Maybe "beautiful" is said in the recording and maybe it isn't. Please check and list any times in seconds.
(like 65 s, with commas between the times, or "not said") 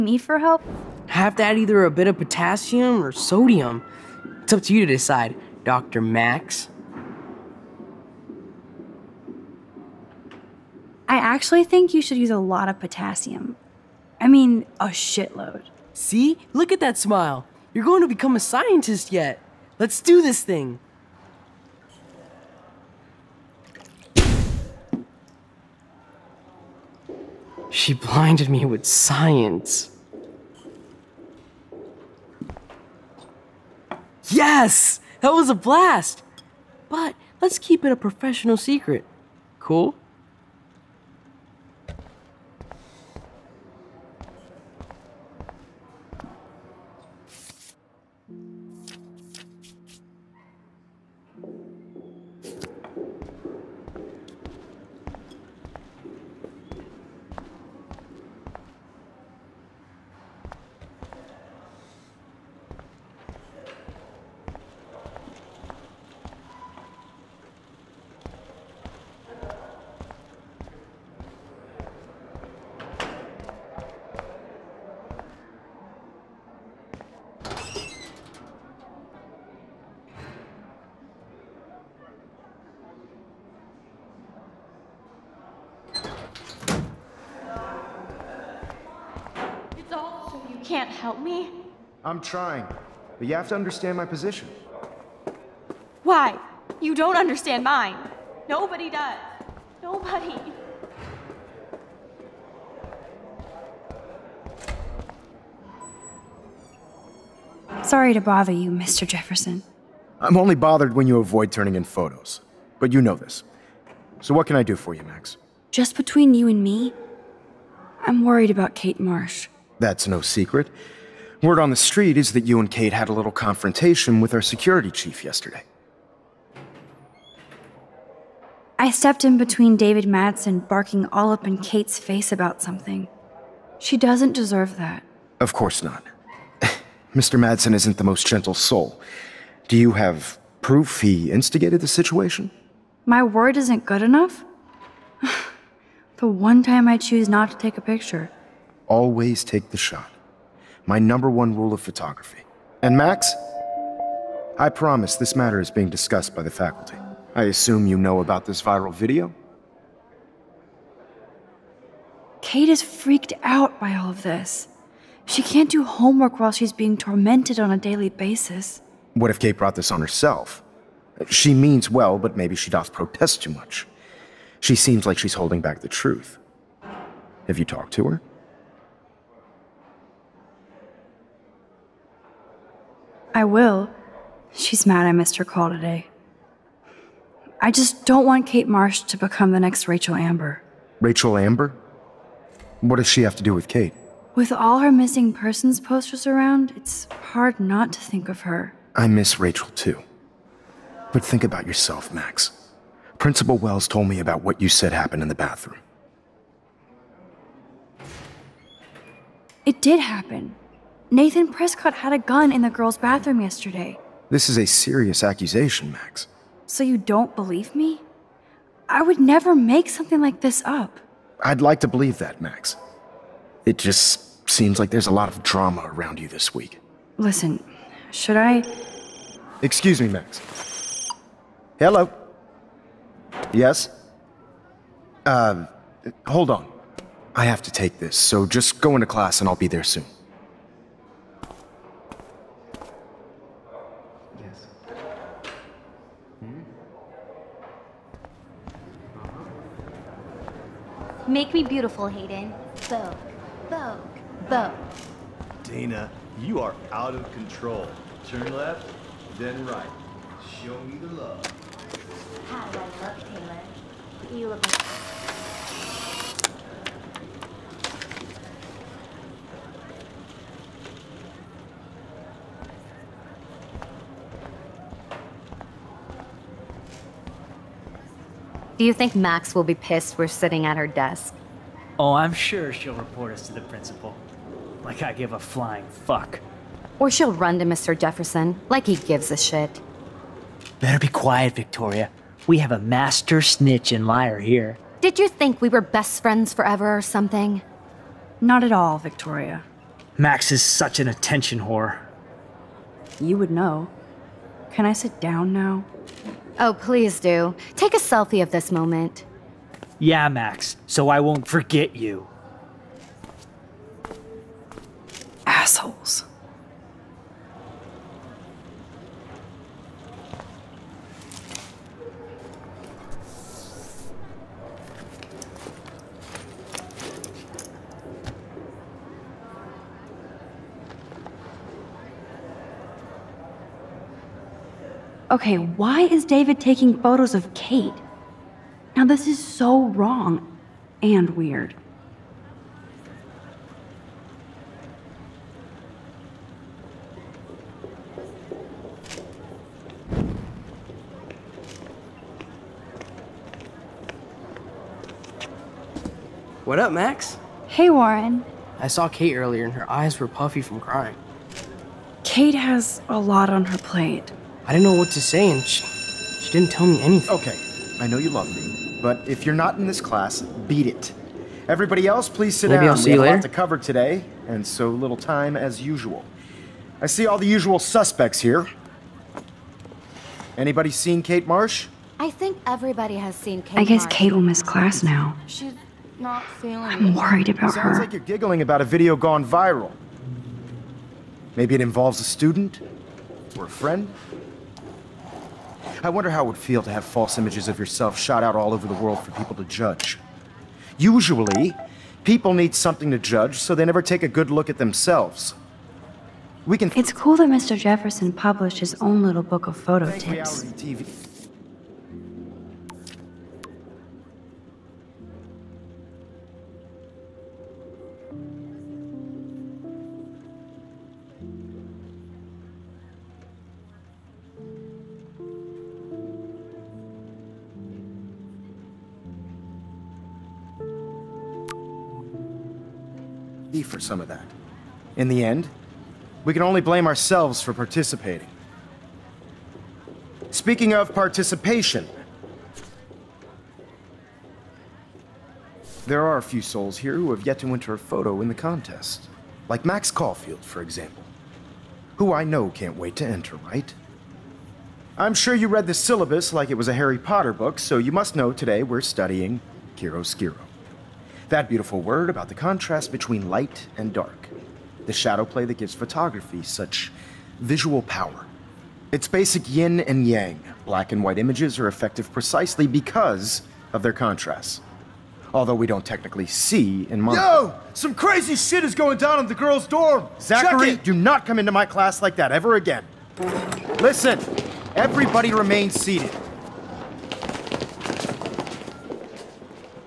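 251 s, 461 s.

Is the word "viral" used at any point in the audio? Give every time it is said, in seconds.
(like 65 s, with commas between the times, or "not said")
158 s, 389 s.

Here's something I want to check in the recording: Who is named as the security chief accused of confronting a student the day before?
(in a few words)
David Madsen.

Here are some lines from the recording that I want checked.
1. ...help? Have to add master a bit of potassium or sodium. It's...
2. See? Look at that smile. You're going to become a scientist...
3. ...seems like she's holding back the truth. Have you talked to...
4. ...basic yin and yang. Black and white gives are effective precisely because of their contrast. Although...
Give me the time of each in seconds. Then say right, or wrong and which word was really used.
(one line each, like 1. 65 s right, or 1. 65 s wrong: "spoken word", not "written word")
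1. 0 s wrong: "either", not "master"
2. 15 s right
3. 174 s right
4. 469 s wrong: "images", not "gives".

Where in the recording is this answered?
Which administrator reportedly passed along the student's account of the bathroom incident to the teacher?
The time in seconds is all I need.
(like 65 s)
203 s.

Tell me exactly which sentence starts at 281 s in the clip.
Oh, I'm sure she'll report us to the principal.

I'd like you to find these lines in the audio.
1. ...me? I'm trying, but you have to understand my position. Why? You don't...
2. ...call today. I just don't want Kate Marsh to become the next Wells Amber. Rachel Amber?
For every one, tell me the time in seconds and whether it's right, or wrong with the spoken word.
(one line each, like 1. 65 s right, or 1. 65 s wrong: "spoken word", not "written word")
1. 91 s right
2. 185 s wrong: "Rachel", not "Wells".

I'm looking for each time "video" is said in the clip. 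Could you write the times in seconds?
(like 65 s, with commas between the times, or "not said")
158 s, 388 s.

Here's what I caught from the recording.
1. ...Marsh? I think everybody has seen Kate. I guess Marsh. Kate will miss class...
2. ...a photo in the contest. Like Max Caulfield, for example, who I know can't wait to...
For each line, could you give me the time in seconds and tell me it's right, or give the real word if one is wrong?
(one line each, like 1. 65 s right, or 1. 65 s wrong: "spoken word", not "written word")
1. 381 s right
2. 447 s right.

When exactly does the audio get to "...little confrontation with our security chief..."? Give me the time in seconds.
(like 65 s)
123 s.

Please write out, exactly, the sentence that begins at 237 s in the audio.
I have to take this, so just go into class and I'll be there soon.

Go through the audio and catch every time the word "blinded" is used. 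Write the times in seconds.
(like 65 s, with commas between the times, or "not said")
27 s.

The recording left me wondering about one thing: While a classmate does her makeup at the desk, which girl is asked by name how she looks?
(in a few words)
Taylor.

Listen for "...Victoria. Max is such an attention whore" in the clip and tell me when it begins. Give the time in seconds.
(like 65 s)
298 s.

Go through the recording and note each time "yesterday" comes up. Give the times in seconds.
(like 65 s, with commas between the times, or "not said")
125 s, 213 s.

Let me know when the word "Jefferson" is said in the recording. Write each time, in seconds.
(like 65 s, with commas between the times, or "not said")
109 s, 287 s, 407 s.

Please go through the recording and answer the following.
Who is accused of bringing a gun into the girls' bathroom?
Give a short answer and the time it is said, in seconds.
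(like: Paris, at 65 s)
Nathan Prescott, at 211 s.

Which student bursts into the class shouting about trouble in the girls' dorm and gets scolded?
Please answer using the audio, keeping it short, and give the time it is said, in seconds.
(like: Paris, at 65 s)
Zachary, at 480 s.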